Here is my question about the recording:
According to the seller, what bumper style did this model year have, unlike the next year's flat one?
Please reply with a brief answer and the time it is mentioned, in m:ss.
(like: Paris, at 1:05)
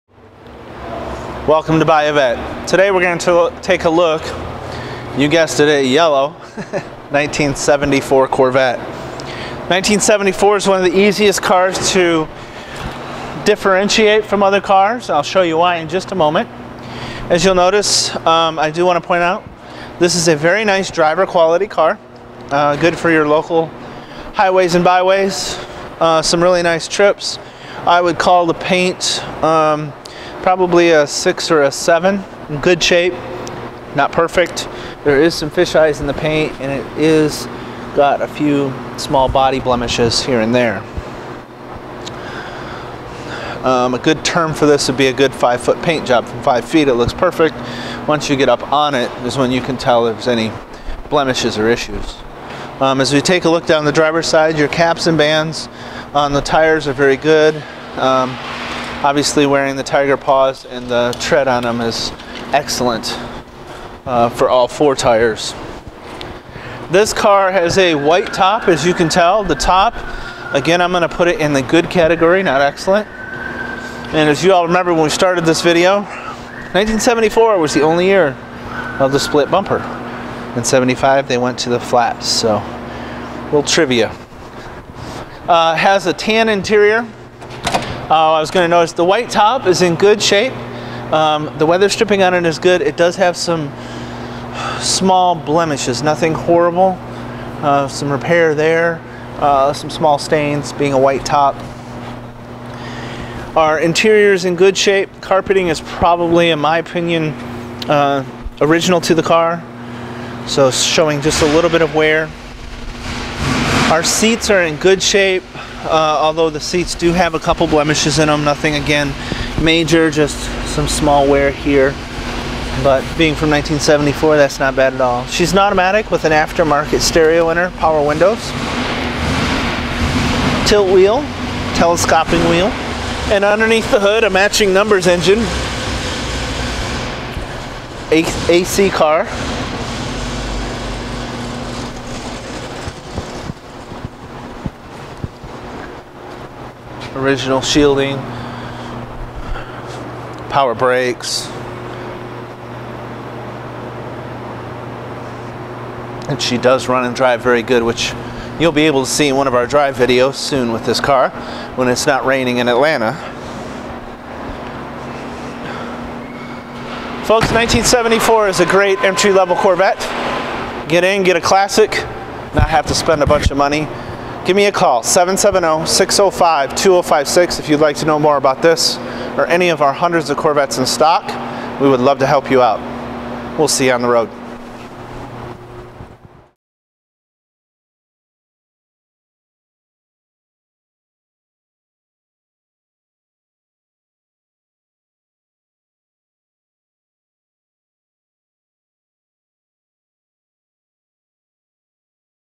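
split bumper, at 1:19.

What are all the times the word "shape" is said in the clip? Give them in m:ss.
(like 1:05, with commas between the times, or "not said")
0:32, 1:30, 1:44, 1:55.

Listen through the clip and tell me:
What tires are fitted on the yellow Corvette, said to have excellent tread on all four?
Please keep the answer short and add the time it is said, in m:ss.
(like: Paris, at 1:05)
Tiger Paws, at 0:59.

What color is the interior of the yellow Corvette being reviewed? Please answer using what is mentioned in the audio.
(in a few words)
tan.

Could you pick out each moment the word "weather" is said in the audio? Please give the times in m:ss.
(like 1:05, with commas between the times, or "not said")
1:31.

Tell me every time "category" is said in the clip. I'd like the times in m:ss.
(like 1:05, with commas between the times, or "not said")
1:11.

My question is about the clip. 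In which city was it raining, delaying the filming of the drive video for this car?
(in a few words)
Atlanta.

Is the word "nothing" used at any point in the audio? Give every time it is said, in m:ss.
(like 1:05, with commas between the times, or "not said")
1:36, 1:58.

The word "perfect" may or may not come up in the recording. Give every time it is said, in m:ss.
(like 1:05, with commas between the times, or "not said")
0:34, 0:47.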